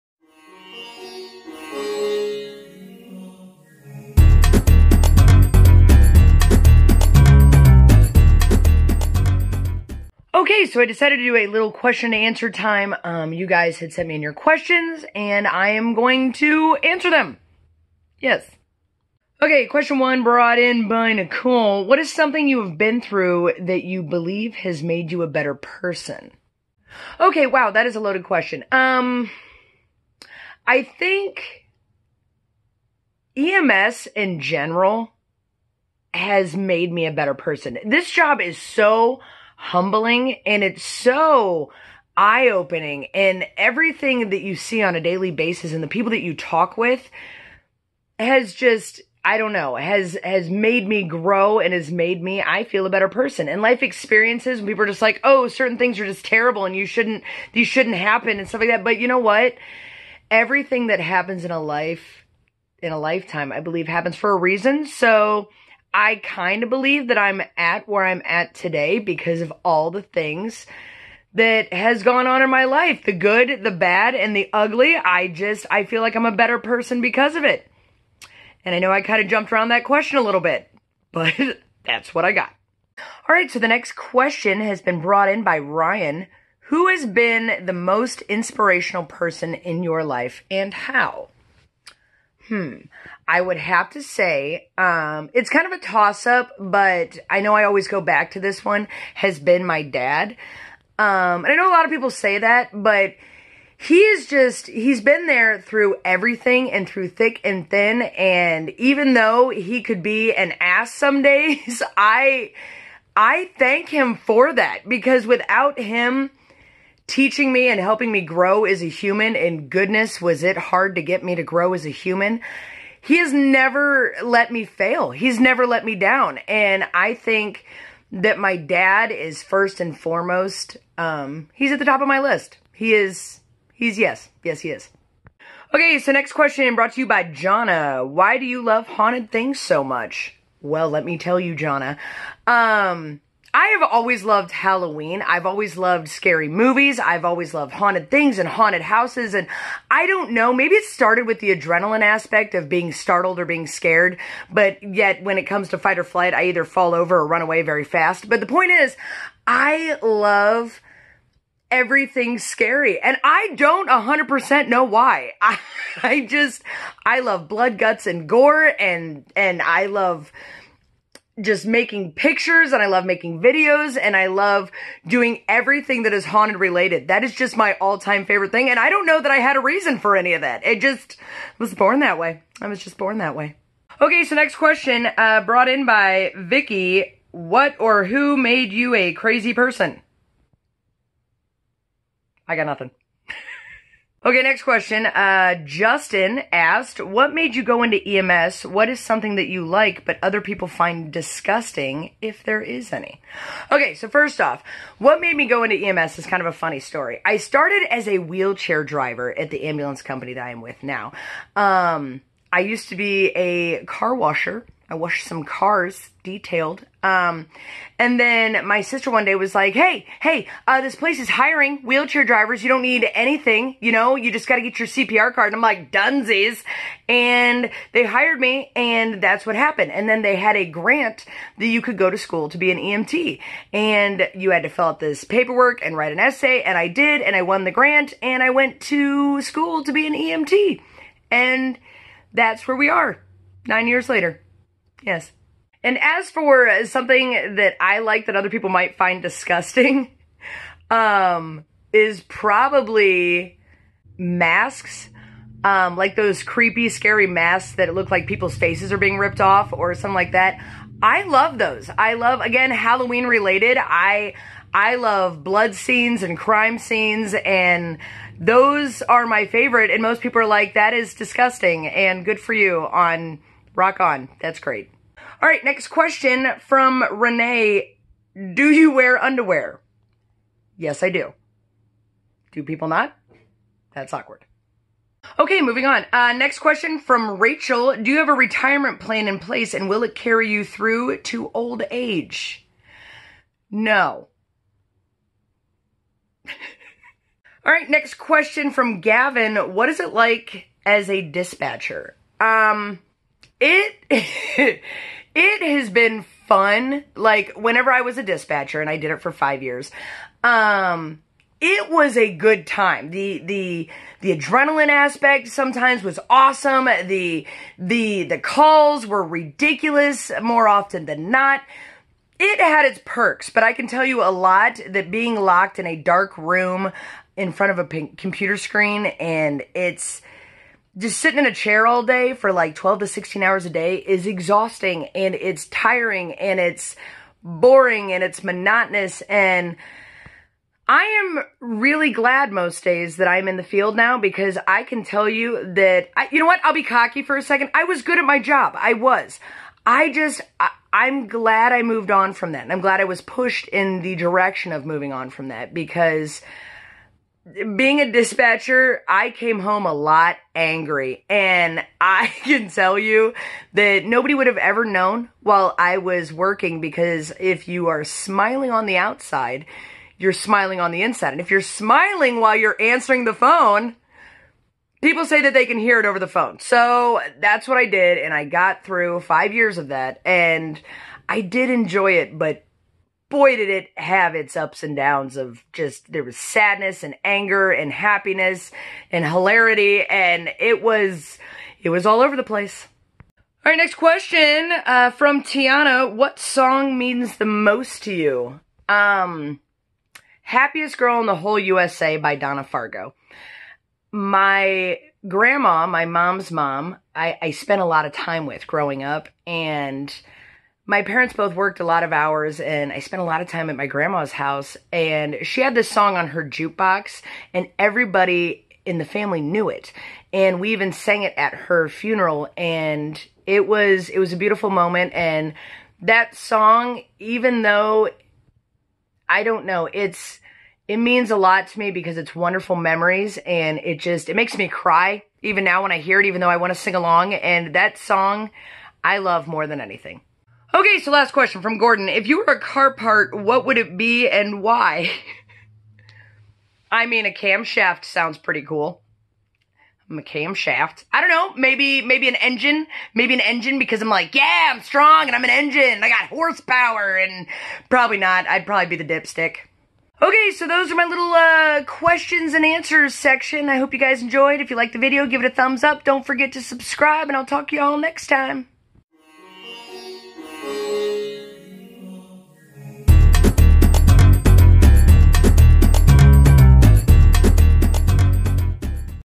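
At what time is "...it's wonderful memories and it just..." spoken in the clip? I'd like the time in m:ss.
7:12.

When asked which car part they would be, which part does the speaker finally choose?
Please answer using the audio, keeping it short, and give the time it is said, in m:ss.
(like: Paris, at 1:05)
The dipstick, at 7:39.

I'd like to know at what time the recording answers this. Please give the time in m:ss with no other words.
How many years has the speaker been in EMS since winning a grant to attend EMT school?
4:03.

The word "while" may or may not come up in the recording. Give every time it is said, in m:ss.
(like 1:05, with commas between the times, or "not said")
6:05, 6:12.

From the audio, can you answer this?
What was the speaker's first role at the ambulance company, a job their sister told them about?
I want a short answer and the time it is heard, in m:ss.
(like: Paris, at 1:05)
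Wheelchair driver, at 3:28.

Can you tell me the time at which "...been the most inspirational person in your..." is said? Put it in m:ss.
1:27.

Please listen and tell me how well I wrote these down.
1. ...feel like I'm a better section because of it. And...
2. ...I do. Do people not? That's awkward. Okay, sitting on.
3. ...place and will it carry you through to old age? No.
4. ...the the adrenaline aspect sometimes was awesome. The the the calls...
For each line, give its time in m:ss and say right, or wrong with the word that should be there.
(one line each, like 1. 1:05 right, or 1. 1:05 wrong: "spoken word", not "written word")
1. 1:15 wrong: "person", not "section"
2. 4:41 wrong: "moving", not "sitting"
3. 4:49 right
4. 5:13 right.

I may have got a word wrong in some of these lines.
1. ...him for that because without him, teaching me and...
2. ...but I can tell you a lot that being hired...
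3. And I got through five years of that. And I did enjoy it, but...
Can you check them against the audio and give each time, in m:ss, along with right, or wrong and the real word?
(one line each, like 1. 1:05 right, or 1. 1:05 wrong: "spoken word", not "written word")
1. 1:53 right
2. 5:23 wrong: "locked", not "hired"
3. 6:18 right.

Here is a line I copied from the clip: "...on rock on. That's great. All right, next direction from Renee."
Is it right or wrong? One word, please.
wrong.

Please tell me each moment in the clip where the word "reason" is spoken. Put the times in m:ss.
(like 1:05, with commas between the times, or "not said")
1:04, 2:59.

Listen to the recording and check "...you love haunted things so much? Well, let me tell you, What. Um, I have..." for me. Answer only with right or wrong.
wrong.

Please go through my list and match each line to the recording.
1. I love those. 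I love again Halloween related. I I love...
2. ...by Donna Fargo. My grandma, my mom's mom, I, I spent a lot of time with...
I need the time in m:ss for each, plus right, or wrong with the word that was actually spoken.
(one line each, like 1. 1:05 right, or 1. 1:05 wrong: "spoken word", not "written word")
1. 4:21 right
2. 6:42 right.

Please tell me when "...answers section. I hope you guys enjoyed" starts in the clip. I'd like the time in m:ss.
7:42.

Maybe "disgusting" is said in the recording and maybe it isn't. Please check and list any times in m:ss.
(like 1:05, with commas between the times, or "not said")
3:21, 4:09, 4:31.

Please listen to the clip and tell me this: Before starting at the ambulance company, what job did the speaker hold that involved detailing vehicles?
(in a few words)
Car washer.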